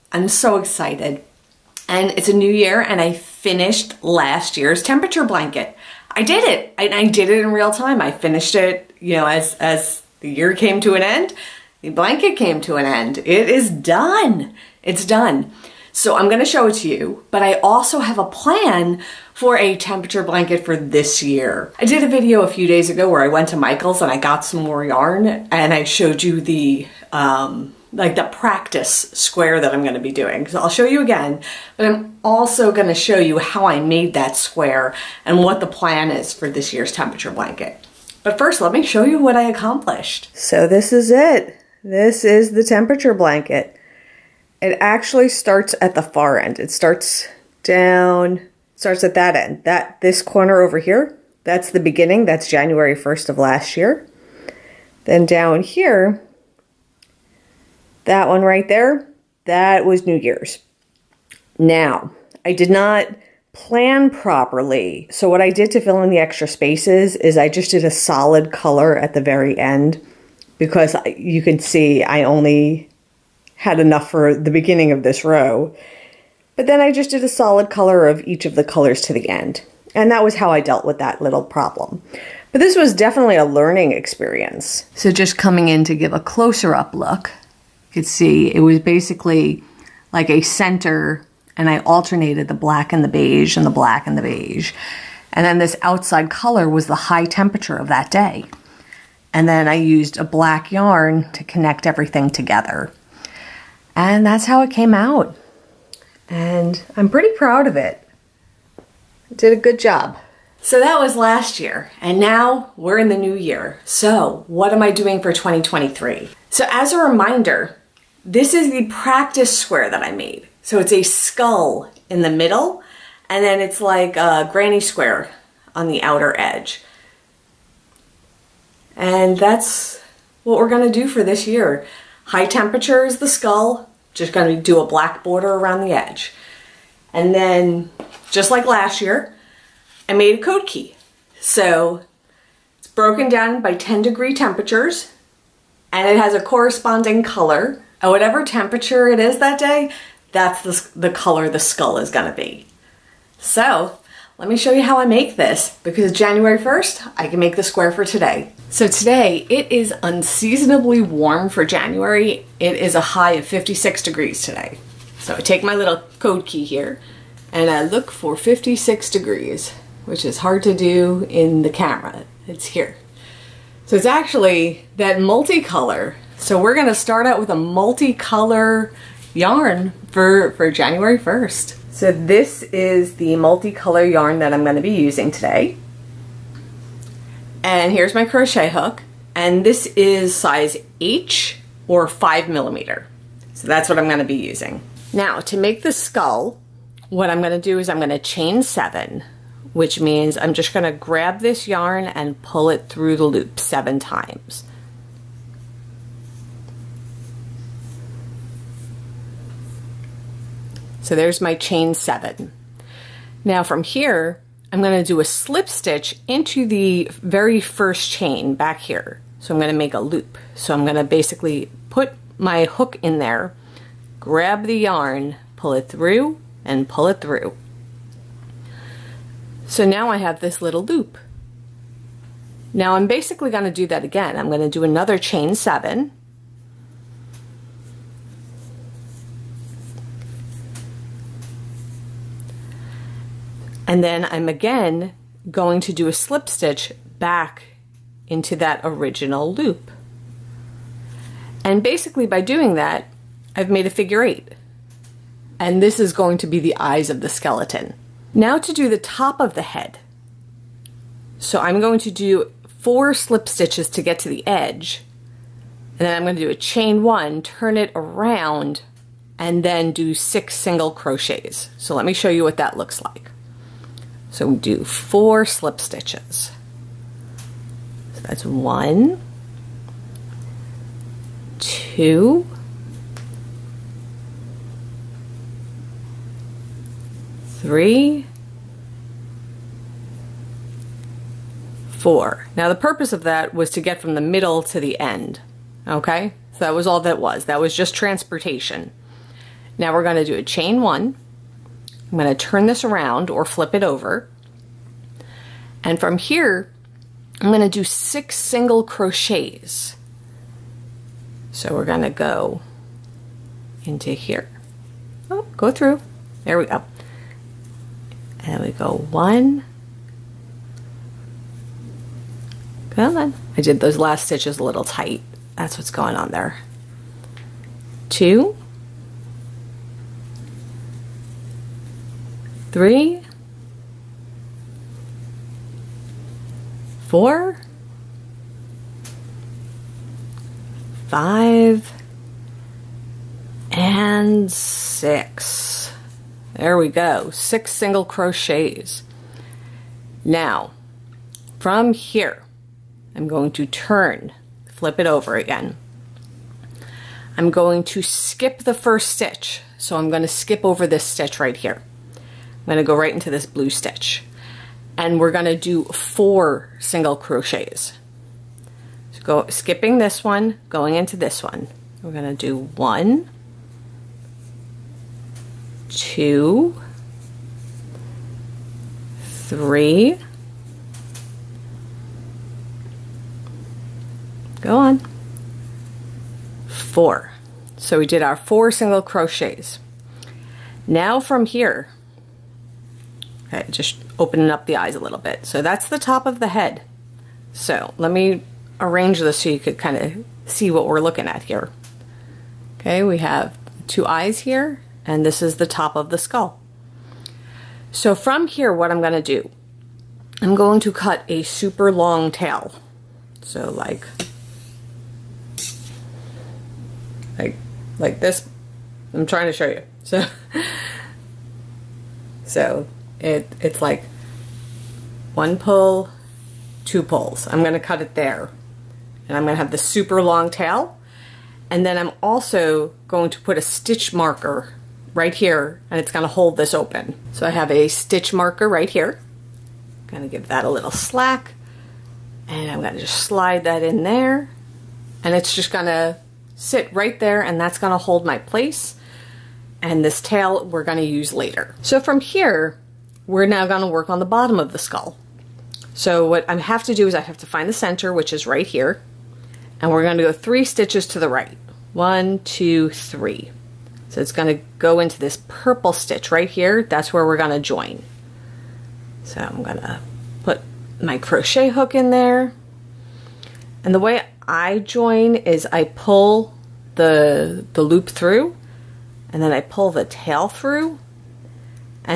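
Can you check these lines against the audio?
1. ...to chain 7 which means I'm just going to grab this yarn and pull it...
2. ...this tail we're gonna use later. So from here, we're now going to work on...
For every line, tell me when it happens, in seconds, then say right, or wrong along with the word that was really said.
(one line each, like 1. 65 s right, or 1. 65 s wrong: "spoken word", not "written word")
1. 198 s right
2. 450 s right.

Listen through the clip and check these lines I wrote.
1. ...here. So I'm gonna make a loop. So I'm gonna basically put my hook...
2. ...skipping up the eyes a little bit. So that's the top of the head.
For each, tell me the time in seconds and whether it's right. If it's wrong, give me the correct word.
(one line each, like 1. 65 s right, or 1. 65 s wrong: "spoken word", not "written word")
1. 218 s right
2. 394 s wrong: "opening", not "skipping".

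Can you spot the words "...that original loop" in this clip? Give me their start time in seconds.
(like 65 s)
248 s.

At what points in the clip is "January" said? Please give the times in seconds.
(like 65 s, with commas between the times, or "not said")
52 s, 156 s, 161 s, 180 s.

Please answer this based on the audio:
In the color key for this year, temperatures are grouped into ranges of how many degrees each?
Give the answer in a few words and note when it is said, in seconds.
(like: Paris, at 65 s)
10 degree, at 143 s.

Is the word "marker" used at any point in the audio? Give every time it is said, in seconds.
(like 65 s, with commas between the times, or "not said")
434 s, 438 s.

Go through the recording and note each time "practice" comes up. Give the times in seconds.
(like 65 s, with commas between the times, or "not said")
28 s, 118 s.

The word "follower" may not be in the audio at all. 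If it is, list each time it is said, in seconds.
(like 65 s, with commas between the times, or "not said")
not said.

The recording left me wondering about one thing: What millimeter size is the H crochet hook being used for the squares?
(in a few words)
5 millimeter.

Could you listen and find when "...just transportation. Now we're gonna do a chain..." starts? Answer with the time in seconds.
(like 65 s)
297 s.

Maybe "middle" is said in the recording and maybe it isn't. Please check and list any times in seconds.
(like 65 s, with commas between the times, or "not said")
122 s, 294 s.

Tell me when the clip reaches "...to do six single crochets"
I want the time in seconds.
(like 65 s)
307 s.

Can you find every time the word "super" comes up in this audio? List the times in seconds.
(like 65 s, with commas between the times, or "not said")
411 s, 429 s.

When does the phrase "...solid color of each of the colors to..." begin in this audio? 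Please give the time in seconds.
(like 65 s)
77 s.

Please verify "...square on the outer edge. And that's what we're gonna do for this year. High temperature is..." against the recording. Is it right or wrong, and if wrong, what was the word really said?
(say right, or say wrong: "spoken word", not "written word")
right.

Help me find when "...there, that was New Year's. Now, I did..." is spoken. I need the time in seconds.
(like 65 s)
58 s.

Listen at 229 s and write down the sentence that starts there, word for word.
So now I have this little loop.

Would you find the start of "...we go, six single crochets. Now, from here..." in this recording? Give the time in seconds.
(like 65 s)
346 s.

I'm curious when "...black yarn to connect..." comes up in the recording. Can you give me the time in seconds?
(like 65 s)
100 s.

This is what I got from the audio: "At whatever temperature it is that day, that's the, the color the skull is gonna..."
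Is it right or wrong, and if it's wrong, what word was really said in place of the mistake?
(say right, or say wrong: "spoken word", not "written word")
right.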